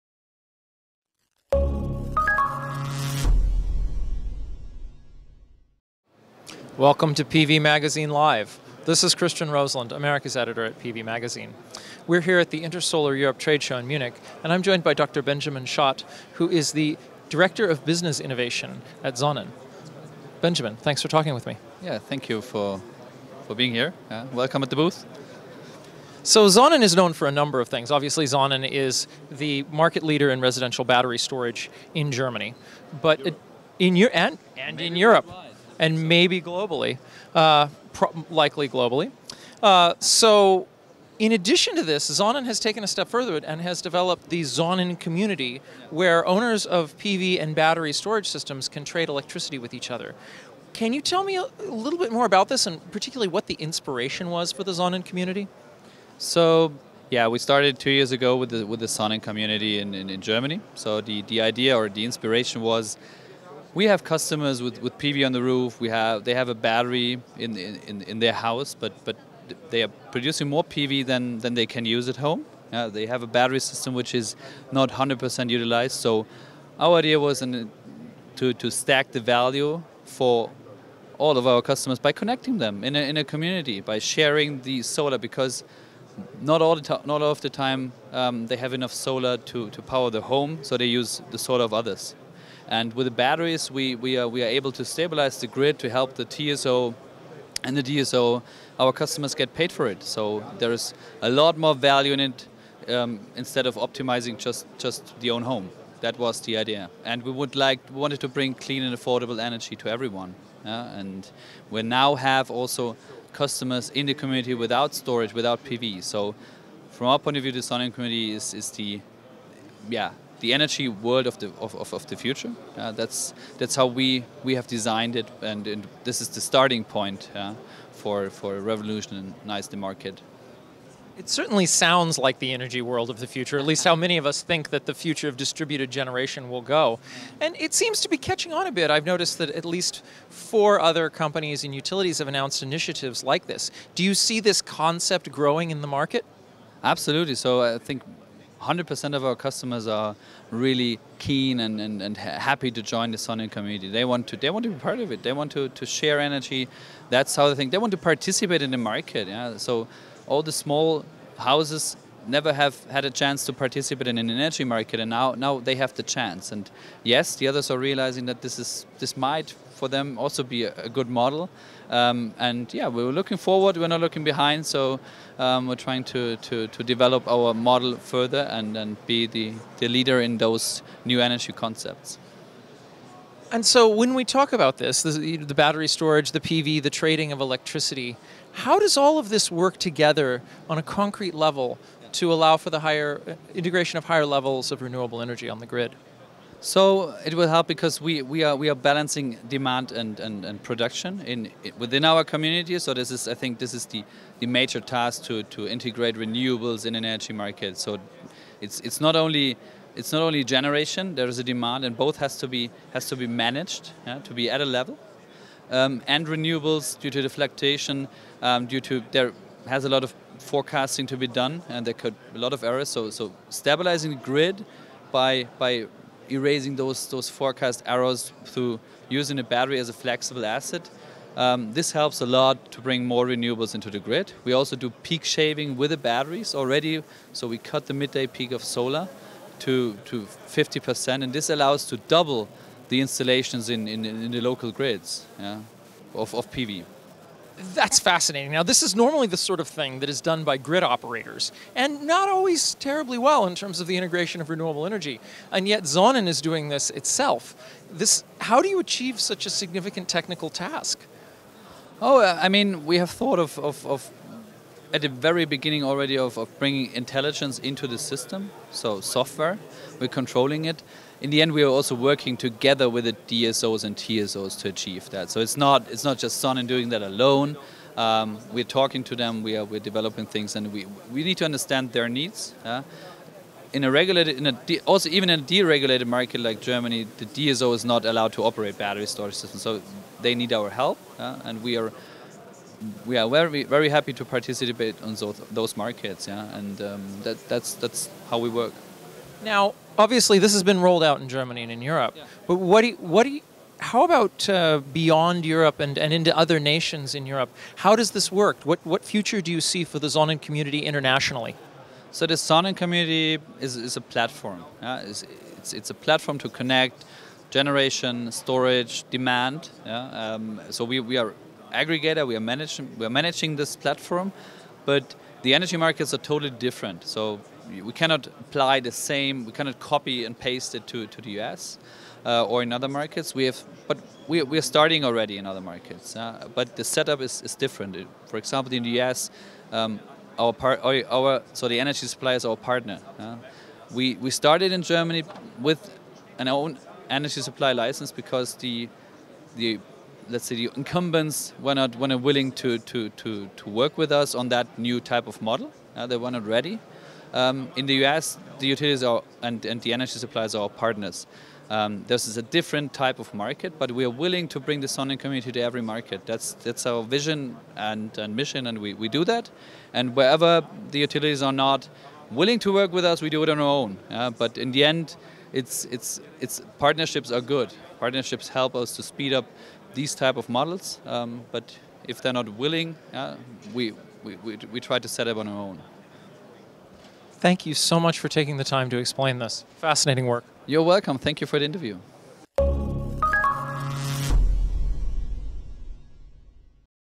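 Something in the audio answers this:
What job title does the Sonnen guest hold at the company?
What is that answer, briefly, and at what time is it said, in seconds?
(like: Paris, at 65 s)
Director of Business Innovation, at 17 s.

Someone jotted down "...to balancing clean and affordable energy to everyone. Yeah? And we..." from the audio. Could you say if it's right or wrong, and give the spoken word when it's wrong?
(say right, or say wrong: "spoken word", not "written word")
wrong: "bring", not "balancing".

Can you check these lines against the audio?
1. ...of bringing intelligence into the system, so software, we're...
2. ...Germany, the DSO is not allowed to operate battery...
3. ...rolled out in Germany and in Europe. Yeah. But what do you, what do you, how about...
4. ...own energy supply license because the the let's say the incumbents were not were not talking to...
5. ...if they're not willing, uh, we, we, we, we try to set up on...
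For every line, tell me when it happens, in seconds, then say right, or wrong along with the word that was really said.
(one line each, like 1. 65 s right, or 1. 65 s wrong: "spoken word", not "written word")
1. 266 s right
2. 286 s right
3. 300 s right
4. 346 s wrong: "willing", not "talking"
5. 382 s right.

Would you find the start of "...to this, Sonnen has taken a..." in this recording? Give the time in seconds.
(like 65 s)
41 s.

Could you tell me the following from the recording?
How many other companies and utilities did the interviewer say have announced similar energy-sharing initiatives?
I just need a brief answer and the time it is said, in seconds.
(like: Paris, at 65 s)
4, at 140 s.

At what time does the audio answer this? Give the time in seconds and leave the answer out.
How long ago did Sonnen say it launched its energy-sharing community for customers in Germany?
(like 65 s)
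57 s.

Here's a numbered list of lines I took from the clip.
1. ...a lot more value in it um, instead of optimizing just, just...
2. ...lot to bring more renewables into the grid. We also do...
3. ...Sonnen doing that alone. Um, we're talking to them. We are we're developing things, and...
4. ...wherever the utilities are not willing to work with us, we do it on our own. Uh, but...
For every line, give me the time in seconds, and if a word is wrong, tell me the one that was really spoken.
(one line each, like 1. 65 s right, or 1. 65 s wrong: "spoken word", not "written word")
1. 101 s right
2. 232 s right
3. 276 s right
4. 370 s right.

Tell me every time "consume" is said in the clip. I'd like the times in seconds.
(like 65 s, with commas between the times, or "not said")
not said.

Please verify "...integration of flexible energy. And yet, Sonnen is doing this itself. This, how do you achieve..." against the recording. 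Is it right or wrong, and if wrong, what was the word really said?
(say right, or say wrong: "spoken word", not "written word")
wrong: "renewable", not "flexible".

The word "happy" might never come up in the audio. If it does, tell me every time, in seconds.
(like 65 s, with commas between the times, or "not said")
152 s, 293 s.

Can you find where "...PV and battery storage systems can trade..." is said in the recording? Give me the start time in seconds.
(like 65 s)
46 s.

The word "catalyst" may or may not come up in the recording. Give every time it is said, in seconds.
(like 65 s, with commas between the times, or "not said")
not said.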